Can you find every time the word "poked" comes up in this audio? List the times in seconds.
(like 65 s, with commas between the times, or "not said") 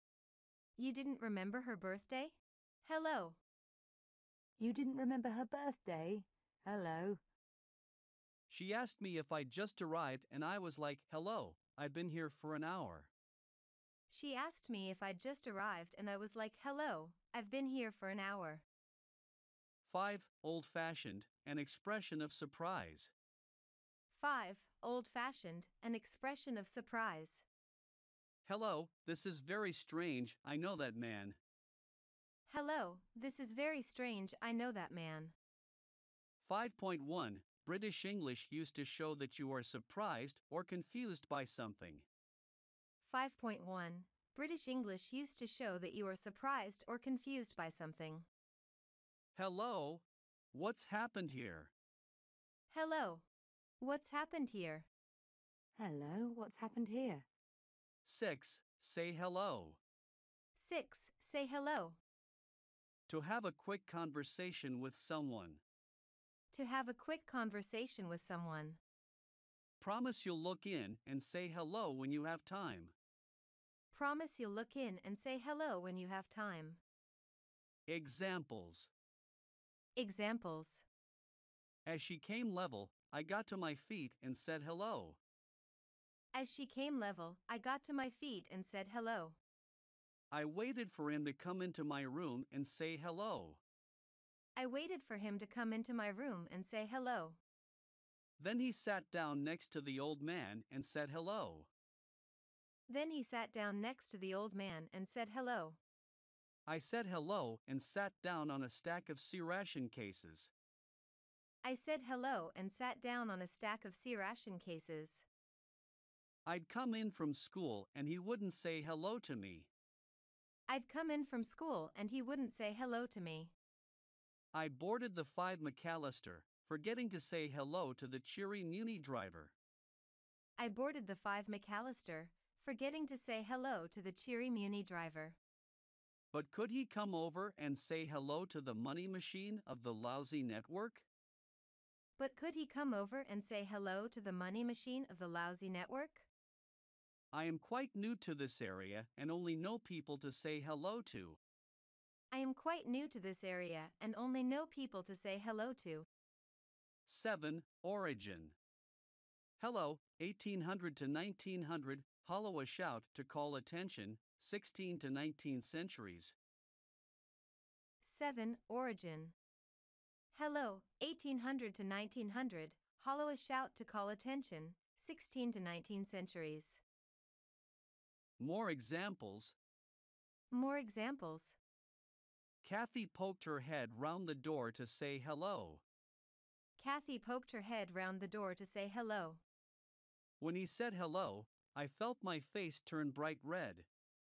183 s, 187 s.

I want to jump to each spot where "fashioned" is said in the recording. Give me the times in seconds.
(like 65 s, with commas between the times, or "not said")
20 s, 25 s.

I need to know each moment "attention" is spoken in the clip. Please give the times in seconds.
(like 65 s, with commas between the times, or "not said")
163 s, 174 s.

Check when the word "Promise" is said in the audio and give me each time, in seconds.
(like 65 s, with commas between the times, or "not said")
69 s, 73 s.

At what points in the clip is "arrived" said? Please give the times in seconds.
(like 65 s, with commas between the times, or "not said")
9 s, 15 s.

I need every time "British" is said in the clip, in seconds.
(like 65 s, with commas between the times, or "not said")
37 s, 44 s.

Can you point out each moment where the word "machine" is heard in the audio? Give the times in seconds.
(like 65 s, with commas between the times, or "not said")
139 s, 144 s.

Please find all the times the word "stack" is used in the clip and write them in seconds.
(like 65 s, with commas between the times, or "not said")
108 s, 113 s.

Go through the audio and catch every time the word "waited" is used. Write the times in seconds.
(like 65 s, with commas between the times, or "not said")
90 s, 94 s.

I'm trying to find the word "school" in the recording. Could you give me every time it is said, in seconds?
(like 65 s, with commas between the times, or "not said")
117 s, 121 s.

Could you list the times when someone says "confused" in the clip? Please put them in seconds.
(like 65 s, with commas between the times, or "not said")
40 s, 46 s.